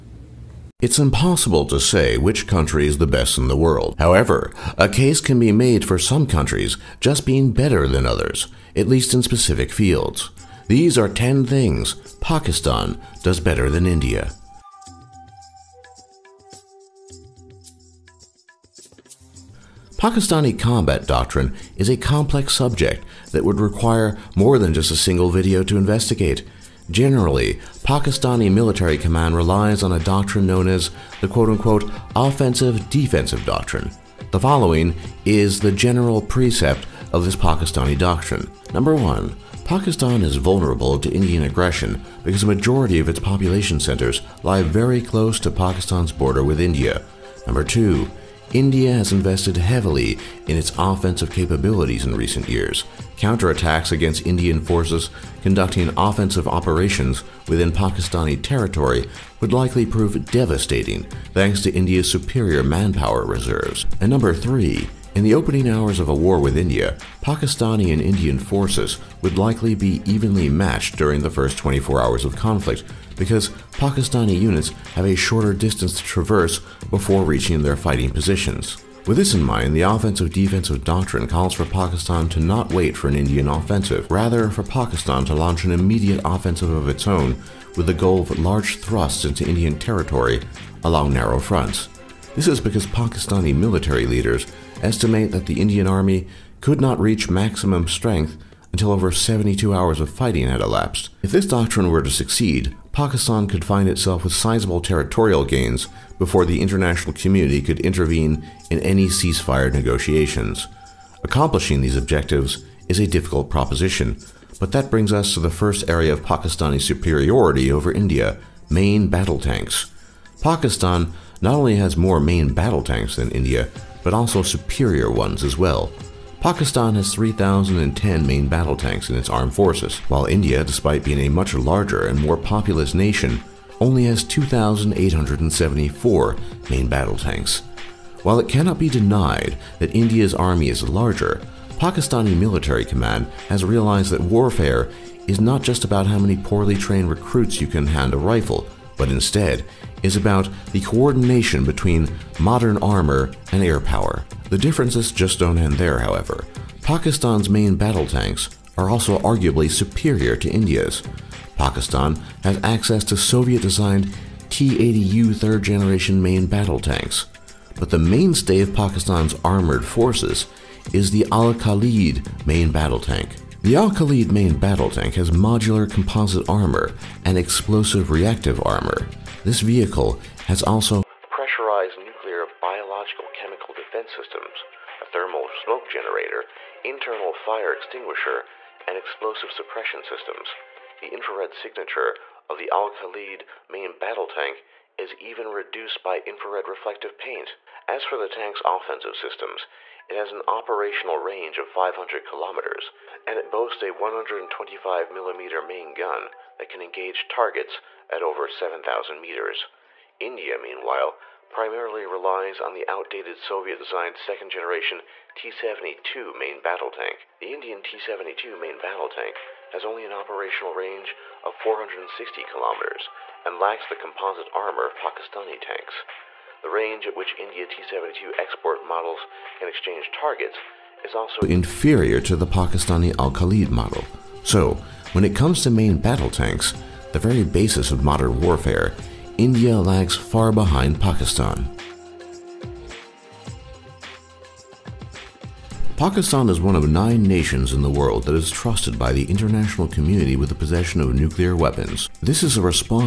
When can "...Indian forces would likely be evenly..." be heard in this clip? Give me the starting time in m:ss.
1:08.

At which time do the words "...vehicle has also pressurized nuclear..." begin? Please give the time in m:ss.
2:59.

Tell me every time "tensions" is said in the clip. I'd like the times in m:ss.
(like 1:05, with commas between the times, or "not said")
not said.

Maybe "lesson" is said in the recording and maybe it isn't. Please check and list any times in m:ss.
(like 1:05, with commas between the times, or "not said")
not said.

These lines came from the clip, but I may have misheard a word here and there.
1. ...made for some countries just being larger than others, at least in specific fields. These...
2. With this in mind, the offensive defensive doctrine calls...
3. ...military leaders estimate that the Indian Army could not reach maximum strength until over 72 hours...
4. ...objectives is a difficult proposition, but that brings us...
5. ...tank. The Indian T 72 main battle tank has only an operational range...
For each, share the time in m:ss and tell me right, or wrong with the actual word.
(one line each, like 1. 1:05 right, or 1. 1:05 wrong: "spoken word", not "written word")
1. 0:05 wrong: "better", not "larger"
2. 1:19 right
3. 1:33 right
4. 1:51 right
5. 3:36 right.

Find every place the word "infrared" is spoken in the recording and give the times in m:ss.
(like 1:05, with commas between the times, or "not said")
3:11, 3:16.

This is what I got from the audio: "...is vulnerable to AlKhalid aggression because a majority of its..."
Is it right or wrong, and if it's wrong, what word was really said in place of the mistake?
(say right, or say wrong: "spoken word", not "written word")
wrong: "Indian", not "AlKhalid".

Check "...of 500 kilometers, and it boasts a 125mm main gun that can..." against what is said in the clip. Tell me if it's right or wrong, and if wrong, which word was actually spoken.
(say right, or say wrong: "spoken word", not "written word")
right.